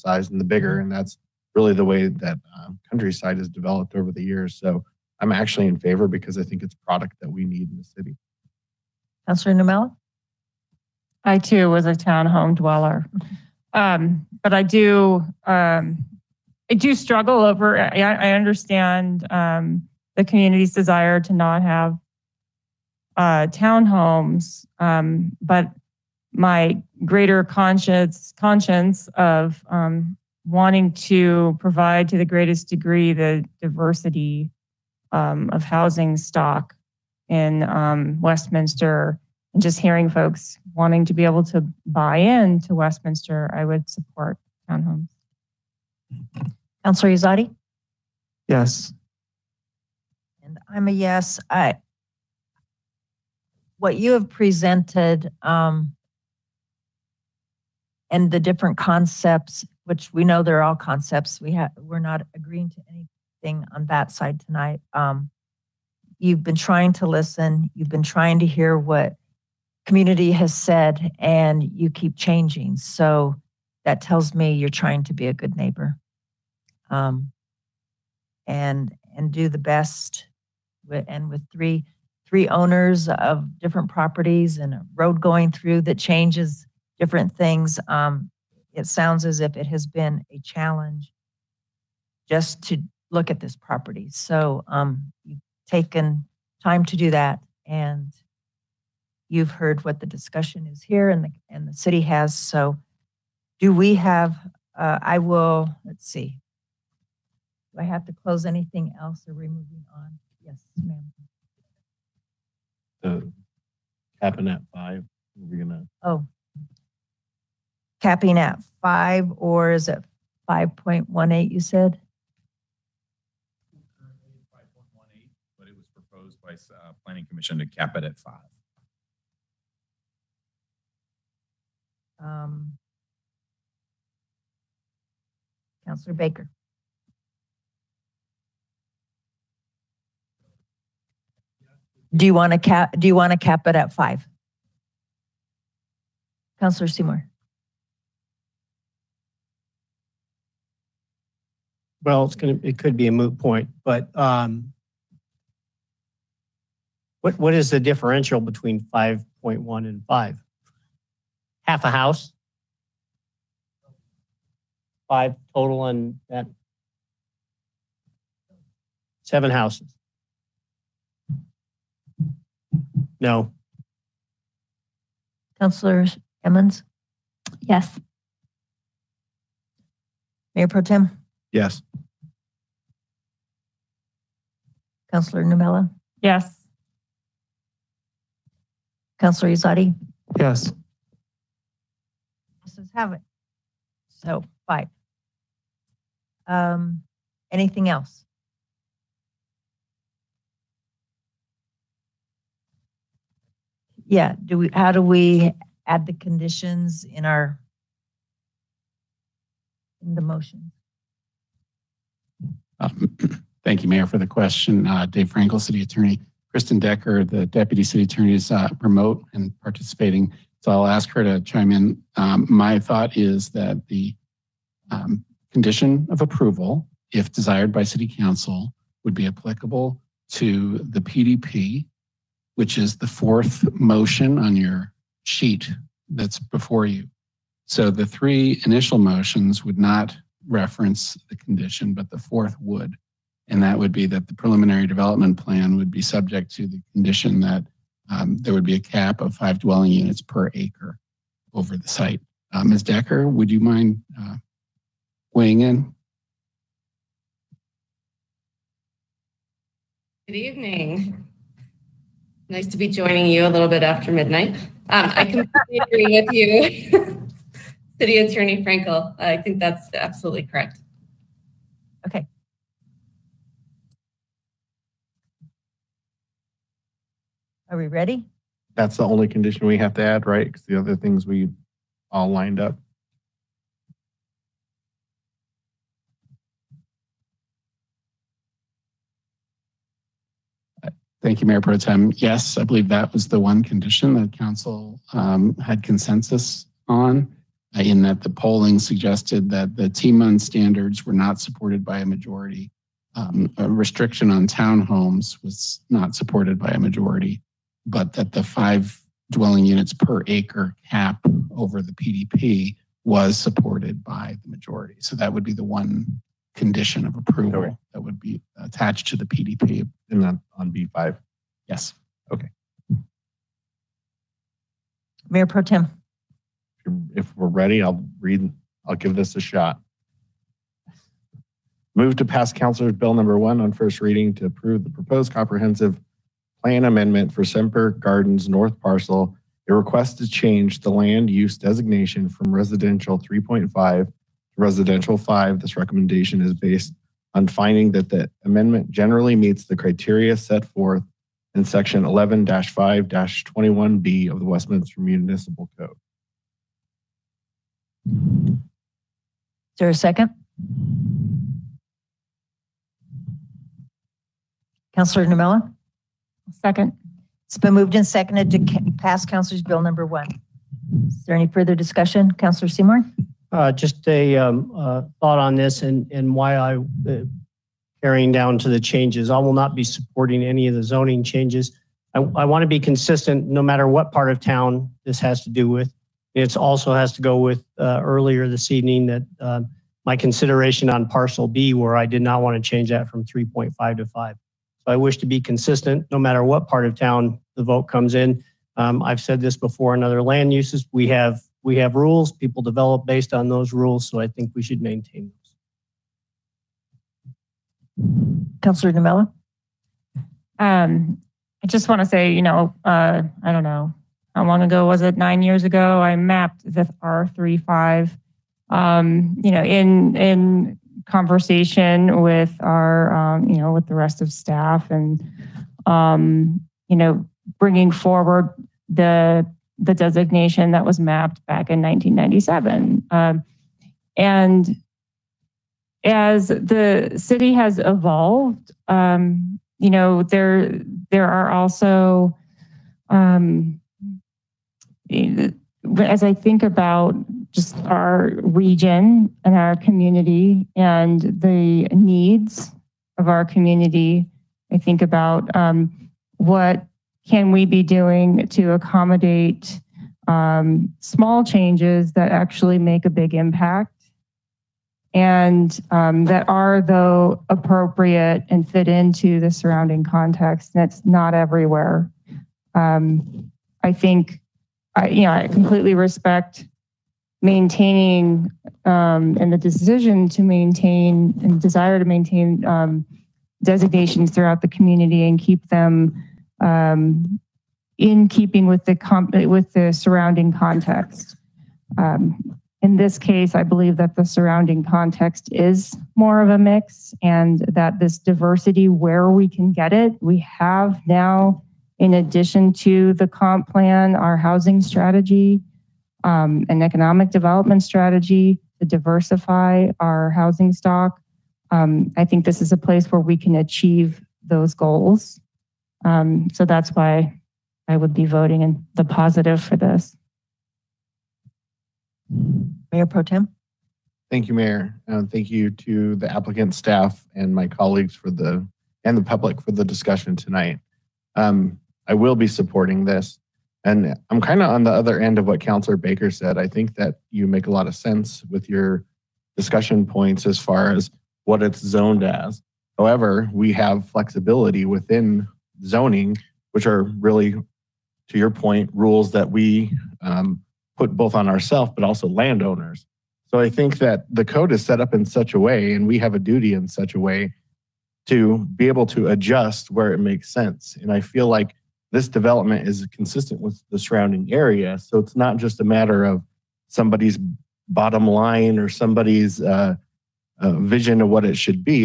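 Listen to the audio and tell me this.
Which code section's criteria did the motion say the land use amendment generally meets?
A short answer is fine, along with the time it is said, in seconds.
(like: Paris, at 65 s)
Section 11 5 21B, at 351 s.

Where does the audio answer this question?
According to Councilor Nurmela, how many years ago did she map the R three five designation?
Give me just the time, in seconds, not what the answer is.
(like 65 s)
415 s.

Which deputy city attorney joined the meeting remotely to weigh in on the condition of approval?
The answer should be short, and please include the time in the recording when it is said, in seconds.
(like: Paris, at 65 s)
Kristen Decker, at 216 s.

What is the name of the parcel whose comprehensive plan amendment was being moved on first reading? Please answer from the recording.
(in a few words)
Semper Gardens North.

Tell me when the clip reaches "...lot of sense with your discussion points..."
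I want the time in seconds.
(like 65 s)
537 s.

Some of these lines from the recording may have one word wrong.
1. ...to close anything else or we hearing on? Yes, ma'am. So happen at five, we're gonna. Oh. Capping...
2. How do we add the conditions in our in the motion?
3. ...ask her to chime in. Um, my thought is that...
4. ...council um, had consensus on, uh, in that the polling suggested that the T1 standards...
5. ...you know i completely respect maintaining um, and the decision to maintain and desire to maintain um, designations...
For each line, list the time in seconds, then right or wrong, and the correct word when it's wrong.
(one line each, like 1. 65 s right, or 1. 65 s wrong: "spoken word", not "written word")
1. 108 s wrong: "moving", not "hearing"
2. 204 s right
3. 220 s right
4. 294 s right
5. 475 s right.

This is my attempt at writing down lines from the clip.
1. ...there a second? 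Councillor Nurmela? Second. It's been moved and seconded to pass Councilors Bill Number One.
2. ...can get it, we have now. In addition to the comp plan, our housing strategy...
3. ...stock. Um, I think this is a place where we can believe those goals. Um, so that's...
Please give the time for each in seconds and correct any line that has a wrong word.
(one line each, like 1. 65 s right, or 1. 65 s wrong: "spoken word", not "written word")
1. 359 s right
2. 499 s right
3. 510 s wrong: "achieve", not "believe".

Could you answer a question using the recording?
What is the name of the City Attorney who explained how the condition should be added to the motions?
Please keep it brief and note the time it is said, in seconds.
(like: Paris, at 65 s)
Dave Frankel, at 215 s.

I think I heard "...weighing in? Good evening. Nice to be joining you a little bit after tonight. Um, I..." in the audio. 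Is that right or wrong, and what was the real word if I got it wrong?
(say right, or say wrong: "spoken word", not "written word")
wrong: "midnight", not "tonight".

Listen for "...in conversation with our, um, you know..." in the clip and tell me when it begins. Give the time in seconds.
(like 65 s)
420 s.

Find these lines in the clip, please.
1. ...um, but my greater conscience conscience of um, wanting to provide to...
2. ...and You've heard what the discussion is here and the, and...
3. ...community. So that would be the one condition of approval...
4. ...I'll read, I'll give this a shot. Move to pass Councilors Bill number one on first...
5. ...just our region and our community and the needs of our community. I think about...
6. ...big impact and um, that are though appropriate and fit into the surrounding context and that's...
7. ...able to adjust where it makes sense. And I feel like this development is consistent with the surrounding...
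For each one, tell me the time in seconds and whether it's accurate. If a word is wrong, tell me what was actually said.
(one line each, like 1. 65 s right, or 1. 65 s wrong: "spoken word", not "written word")
1. 24 s right
2. 97 s right
3. 314 s wrong: "majority", not "community"
4. 327 s right
5. 447 s right
6. 463 s right
7. 558 s right.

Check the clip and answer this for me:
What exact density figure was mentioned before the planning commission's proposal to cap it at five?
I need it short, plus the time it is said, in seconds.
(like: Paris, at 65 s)
5.18, at 122 s.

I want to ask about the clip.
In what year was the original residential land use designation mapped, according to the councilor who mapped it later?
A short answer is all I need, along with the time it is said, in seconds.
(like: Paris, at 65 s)
1997, at 431 s.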